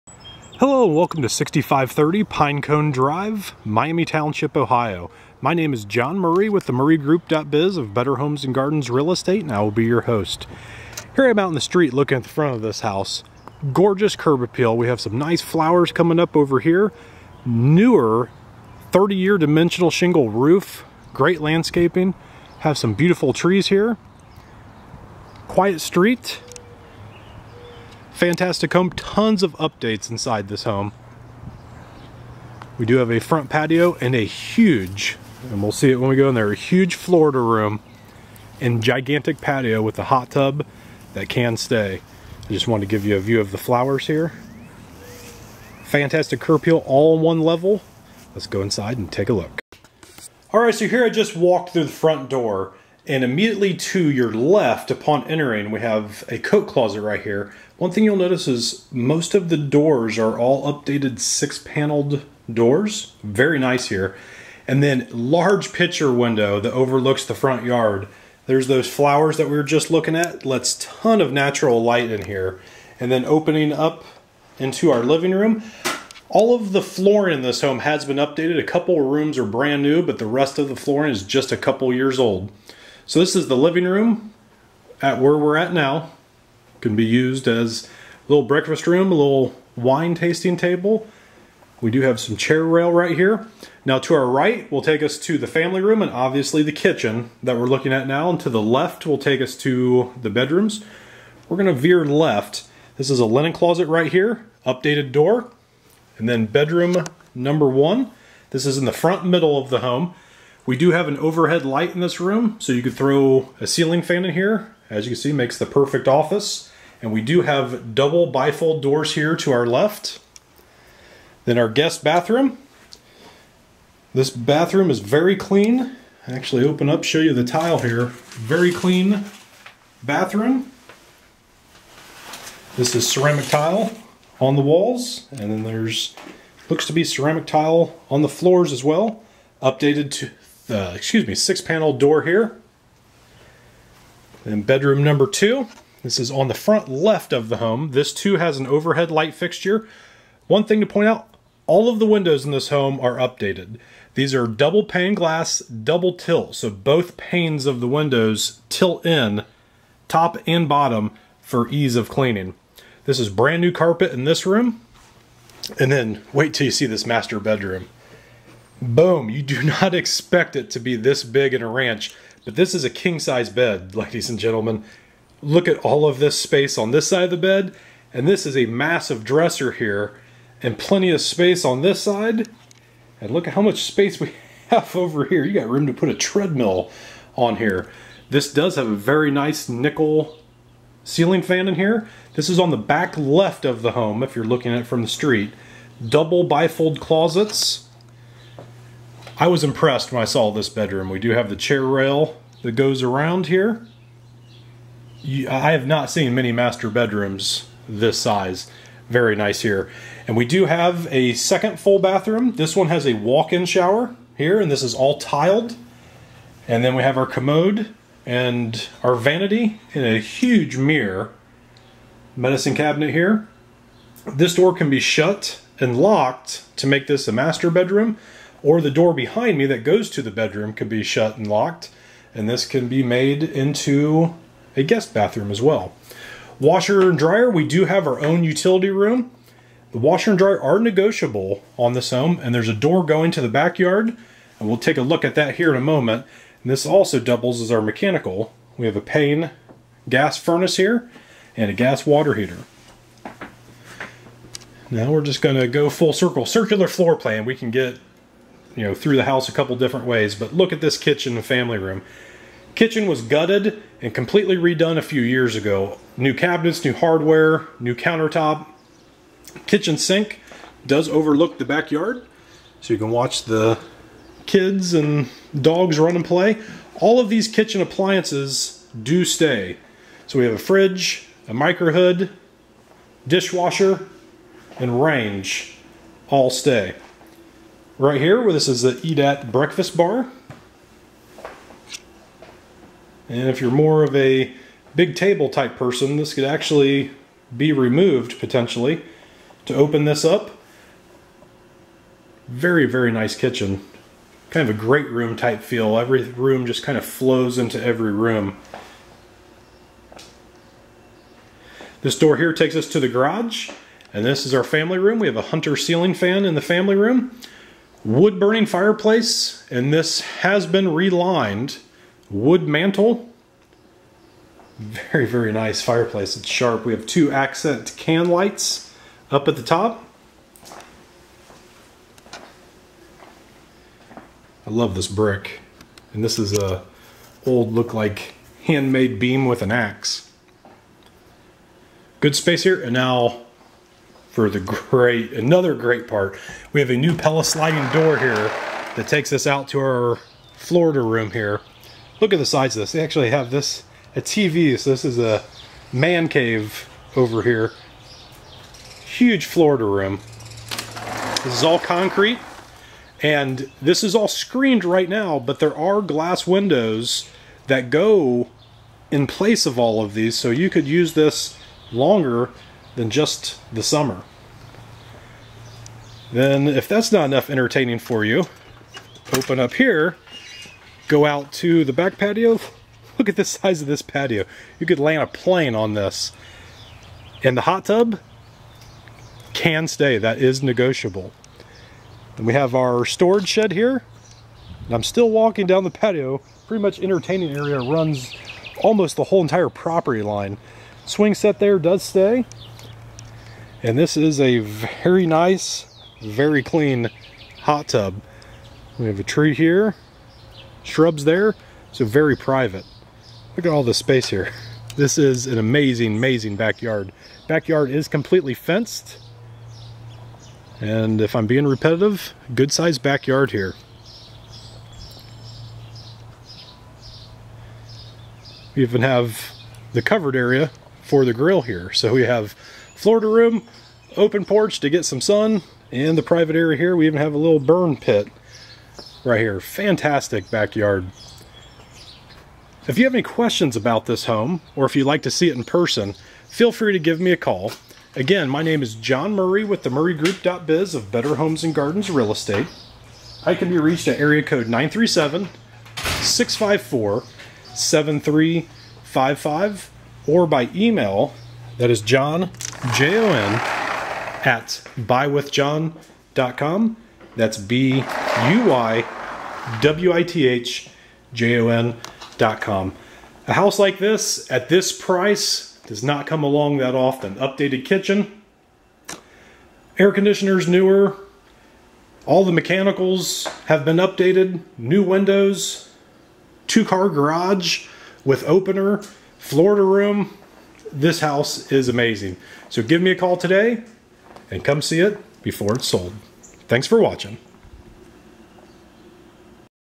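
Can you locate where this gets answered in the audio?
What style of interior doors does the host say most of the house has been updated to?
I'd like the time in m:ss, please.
1:01.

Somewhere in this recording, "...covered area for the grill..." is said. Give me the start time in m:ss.
7:10.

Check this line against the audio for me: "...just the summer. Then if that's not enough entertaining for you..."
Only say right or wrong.
right.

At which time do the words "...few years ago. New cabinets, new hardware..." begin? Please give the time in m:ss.
4:25.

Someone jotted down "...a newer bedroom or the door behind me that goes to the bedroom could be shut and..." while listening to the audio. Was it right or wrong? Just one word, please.
wrong.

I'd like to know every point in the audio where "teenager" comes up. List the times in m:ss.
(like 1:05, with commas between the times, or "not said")
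not said.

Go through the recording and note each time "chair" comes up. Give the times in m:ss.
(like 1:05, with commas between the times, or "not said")
1:32, 3:21.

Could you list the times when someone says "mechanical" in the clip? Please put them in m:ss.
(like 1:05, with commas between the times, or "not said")
4:07, 8:02.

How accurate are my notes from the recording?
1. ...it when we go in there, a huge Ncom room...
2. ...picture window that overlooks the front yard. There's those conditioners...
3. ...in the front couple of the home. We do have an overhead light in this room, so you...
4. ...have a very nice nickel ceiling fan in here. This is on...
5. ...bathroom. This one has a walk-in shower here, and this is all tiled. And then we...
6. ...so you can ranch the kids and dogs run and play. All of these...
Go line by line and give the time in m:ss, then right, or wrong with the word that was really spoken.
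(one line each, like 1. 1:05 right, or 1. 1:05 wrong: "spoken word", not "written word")
1. 0:35 wrong: "Florida", not "Ncom"
2. 1:05 wrong: "flowers", not "conditioners"
3. 1:48 wrong: "middle", not "couple"
4. 3:08 right
5. 3:31 right
6. 4:32 wrong: "watch", not "ranch".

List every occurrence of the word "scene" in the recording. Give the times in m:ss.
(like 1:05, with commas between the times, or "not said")
not said.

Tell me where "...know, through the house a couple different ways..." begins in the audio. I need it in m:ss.
4:18.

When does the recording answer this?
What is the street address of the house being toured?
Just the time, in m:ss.
0:01.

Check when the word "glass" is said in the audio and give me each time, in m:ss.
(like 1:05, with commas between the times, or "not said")
2:35, 6:06.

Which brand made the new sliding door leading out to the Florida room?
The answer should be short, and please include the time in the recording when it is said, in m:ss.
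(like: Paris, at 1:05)
Pella, at 5:47.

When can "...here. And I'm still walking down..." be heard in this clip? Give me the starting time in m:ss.
6:33.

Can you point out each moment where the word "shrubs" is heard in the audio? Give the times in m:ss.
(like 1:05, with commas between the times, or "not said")
6:50.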